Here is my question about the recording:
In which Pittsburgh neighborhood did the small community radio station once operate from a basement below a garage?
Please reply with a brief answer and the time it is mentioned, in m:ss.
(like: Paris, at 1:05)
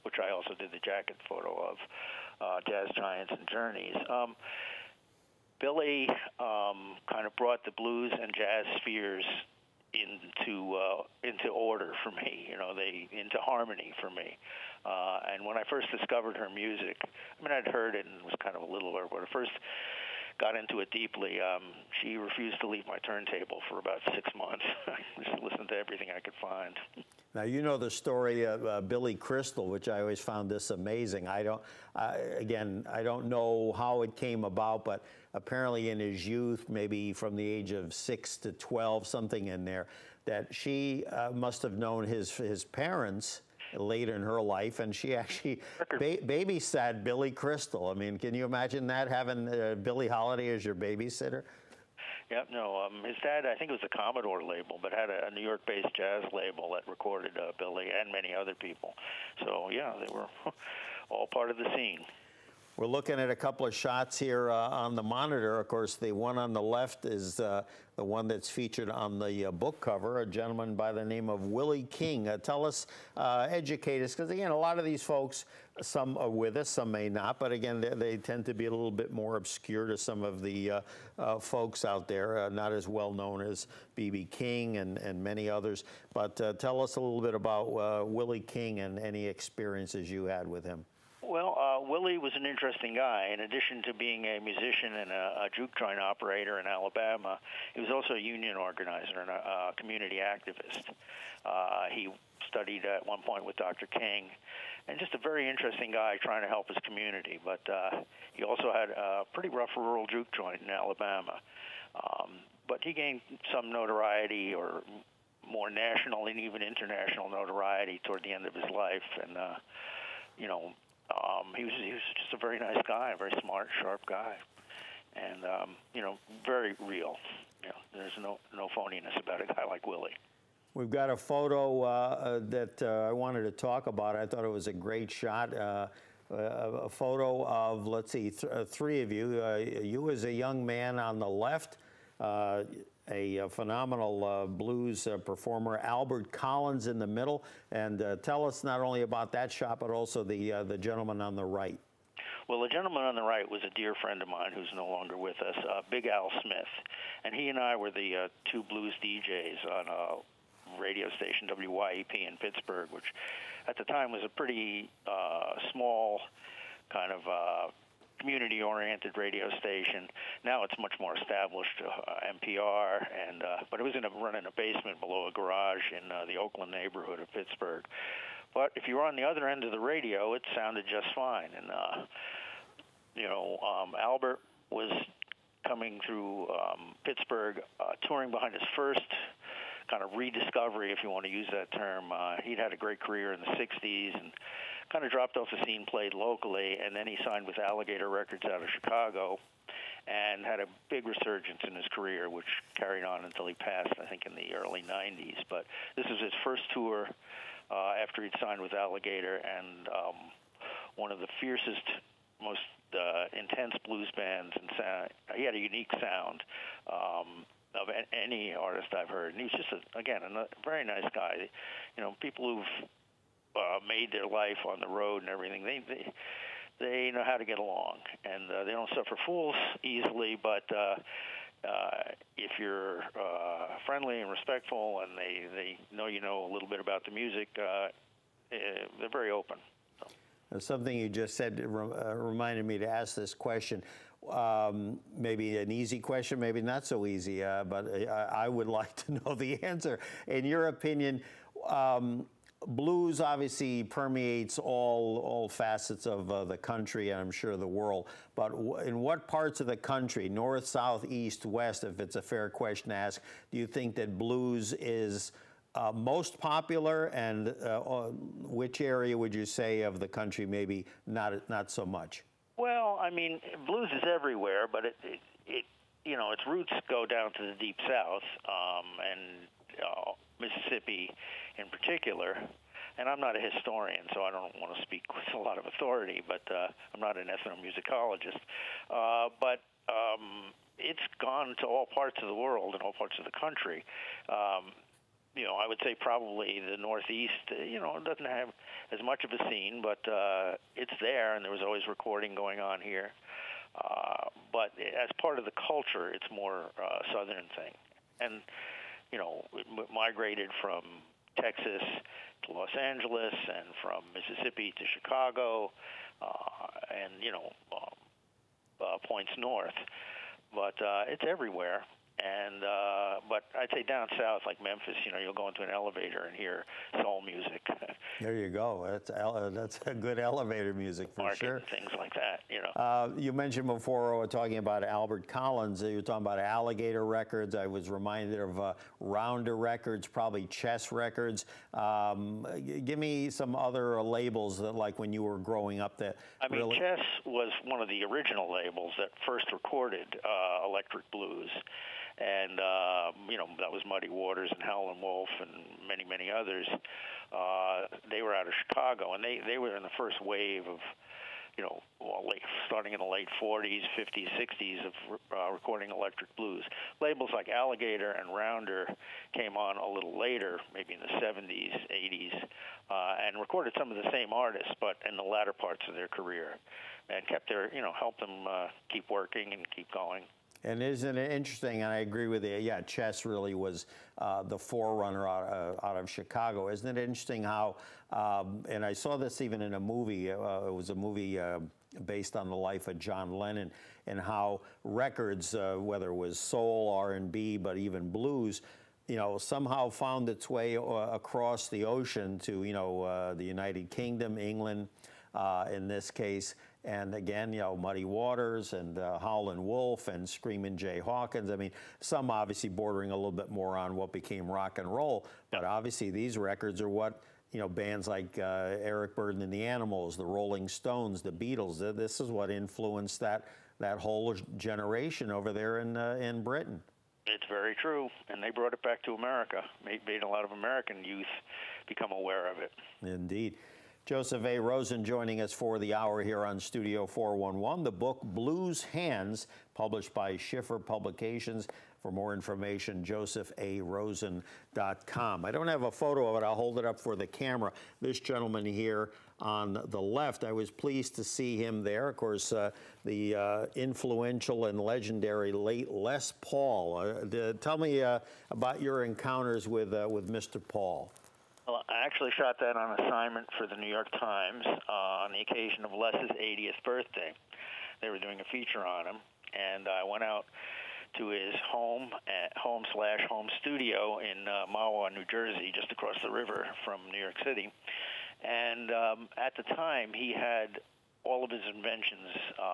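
Oakland, at 2:56.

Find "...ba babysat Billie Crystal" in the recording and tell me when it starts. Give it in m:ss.
0:45.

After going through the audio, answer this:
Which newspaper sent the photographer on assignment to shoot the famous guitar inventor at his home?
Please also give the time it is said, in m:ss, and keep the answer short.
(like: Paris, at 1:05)
New York Times, at 7:43.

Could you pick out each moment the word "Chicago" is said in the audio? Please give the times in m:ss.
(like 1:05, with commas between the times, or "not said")
3:18, 5:14, 5:58, 6:26.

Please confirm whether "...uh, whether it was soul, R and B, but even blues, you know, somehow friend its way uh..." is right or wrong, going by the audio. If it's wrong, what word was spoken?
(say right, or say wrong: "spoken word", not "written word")
wrong: "found", not "friend".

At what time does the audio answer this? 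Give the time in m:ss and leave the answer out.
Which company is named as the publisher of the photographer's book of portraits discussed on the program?
7:20.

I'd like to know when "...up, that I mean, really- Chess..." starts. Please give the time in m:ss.
5:45.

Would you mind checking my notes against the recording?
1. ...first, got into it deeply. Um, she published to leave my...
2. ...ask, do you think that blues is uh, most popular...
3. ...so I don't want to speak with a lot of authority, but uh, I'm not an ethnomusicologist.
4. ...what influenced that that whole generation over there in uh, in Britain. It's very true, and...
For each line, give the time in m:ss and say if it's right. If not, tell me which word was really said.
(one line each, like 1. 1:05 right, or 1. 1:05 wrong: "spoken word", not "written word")
1. 0:19 wrong: "refused", not "published"
2. 4:22 right
3. 4:44 right
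4. 7:02 right.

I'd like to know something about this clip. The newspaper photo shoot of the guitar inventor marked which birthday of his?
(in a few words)
80th.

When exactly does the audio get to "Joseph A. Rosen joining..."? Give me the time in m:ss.
7:14.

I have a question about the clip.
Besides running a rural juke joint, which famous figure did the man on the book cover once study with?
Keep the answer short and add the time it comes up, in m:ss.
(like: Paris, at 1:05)
Dr. King, at 1:43.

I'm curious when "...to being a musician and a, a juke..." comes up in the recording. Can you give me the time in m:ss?
1:33.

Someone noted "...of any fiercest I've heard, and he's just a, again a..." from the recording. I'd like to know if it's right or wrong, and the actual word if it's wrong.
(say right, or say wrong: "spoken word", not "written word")
wrong: "artist", not "fiercest".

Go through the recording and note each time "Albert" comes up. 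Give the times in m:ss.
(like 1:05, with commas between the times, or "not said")
2:25, 3:03, 5:34.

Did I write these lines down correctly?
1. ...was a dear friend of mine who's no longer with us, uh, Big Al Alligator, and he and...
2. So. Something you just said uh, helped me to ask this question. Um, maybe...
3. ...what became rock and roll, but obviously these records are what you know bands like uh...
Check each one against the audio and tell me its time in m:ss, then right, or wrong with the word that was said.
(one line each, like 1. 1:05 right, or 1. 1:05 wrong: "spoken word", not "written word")
1. 2:33 wrong: "Smith", not "Alligator"
2. 4:00 wrong: "reminded", not "helped"
3. 6:53 right.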